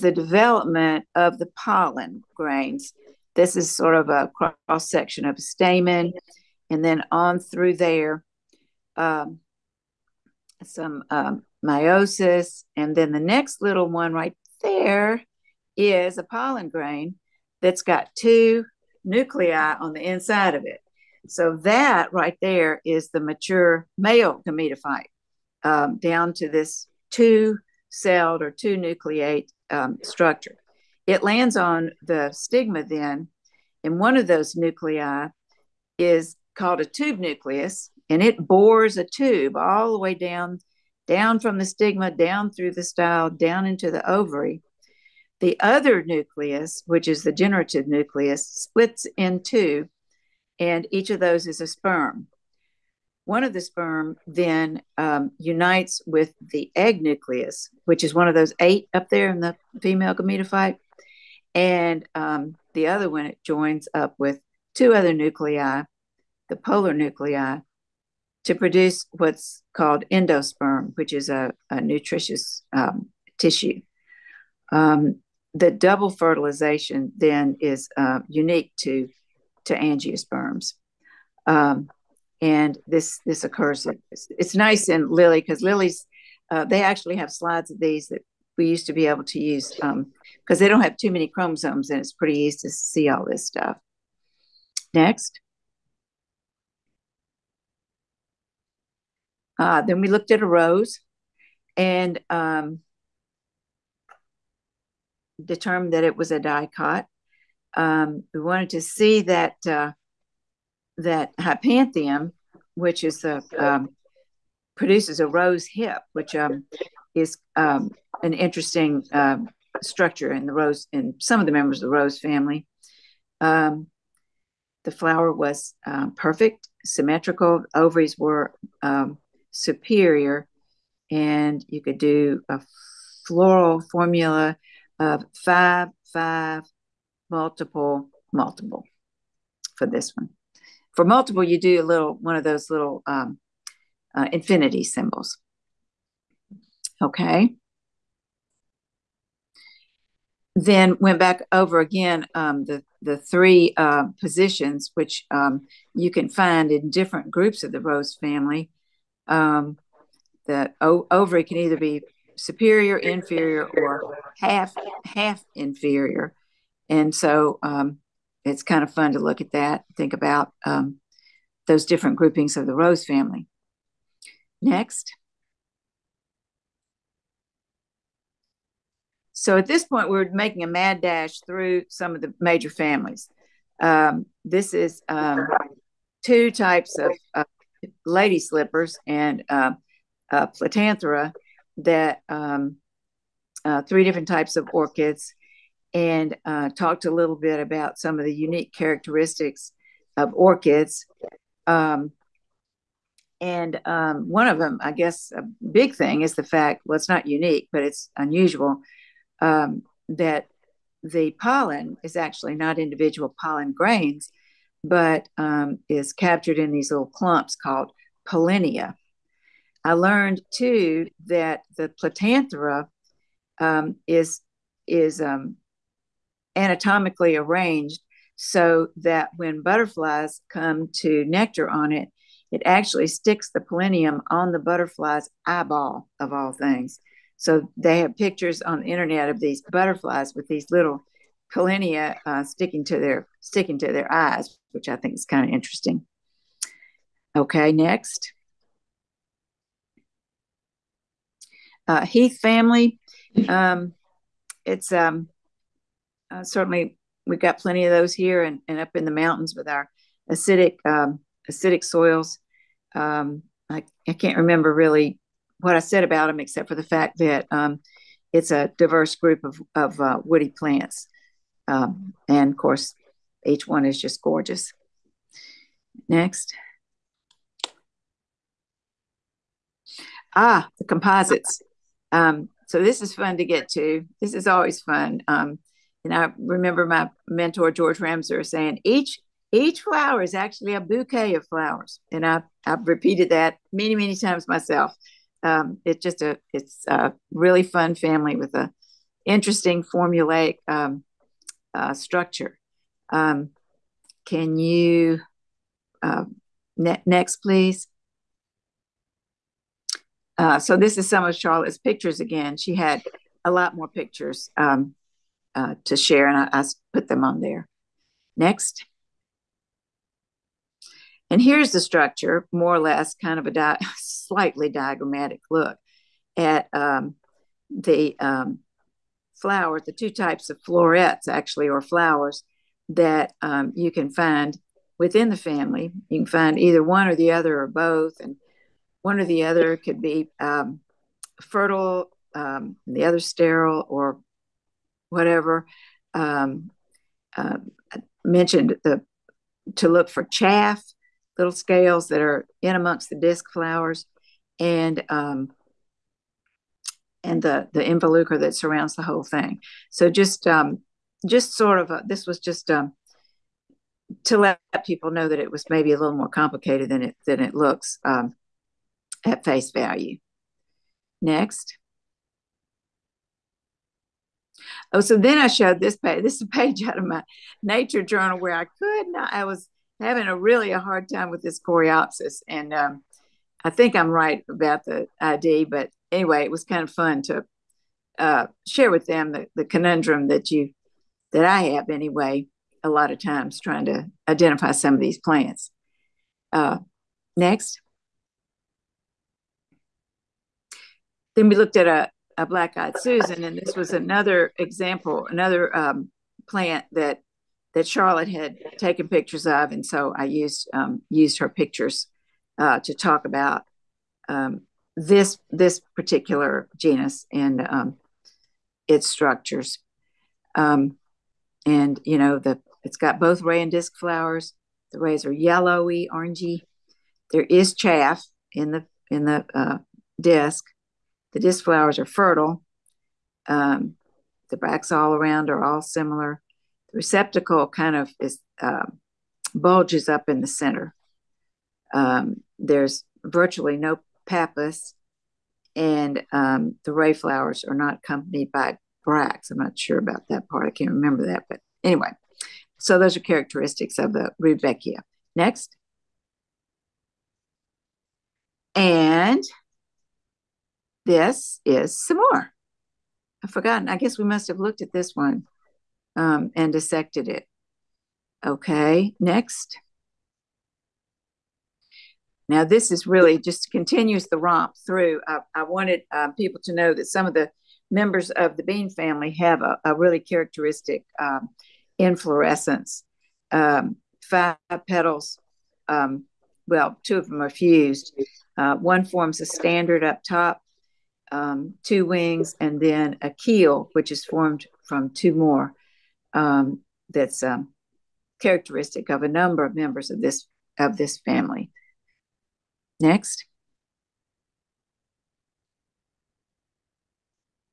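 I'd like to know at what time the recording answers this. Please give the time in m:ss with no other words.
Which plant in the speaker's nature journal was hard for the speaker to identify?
6:21.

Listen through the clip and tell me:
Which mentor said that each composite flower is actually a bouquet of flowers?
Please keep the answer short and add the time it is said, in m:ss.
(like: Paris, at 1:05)
George Ramseur, at 4:47.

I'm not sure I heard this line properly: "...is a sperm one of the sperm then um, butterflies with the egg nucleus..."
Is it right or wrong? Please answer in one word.
wrong.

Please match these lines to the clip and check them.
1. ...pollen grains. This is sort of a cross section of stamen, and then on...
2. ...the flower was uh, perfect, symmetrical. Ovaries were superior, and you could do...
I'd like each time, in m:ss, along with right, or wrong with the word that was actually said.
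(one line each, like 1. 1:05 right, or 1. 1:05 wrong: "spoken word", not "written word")
1. 0:01 right
2. 2:04 right.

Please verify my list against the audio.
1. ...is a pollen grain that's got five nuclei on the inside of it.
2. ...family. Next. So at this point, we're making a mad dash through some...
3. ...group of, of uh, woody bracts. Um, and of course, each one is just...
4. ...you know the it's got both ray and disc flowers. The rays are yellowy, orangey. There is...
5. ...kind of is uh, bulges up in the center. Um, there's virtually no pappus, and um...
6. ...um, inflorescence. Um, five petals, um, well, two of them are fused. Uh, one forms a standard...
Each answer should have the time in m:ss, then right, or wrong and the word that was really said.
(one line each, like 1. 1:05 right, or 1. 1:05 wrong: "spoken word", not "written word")
1. 0:15 wrong: "two", not "five"
2. 2:53 right
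3. 4:29 wrong: "plants", not "bracts"
4. 7:02 right
5. 7:17 right
6. 8:01 right.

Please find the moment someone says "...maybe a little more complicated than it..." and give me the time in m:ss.
6:05.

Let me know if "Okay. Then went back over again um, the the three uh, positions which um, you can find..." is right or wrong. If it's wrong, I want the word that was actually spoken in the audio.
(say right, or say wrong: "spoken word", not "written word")
right.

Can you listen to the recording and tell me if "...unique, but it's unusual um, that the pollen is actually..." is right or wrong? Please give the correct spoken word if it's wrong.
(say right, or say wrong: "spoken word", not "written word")
right.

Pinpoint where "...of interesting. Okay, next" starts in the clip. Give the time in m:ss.
4:05.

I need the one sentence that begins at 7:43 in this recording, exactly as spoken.
I guess we must have looked at this one um, and dissected it.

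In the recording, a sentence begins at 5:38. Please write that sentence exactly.
And one or the other could be um, fertile, um, the other sterile, or whatever.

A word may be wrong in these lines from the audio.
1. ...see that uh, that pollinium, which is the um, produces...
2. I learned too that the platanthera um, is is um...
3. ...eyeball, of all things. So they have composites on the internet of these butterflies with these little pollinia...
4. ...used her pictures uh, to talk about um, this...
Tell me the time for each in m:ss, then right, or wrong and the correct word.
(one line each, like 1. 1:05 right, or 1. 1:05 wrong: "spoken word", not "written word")
1. 1:48 wrong: "hypanthium", not "pollinium"
2. 3:39 right
3. 3:55 wrong: "pictures", not "composites"
4. 6:51 right.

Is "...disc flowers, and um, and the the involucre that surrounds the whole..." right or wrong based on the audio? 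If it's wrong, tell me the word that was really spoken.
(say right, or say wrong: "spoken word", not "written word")
right.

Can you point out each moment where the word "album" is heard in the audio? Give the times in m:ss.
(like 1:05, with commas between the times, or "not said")
not said.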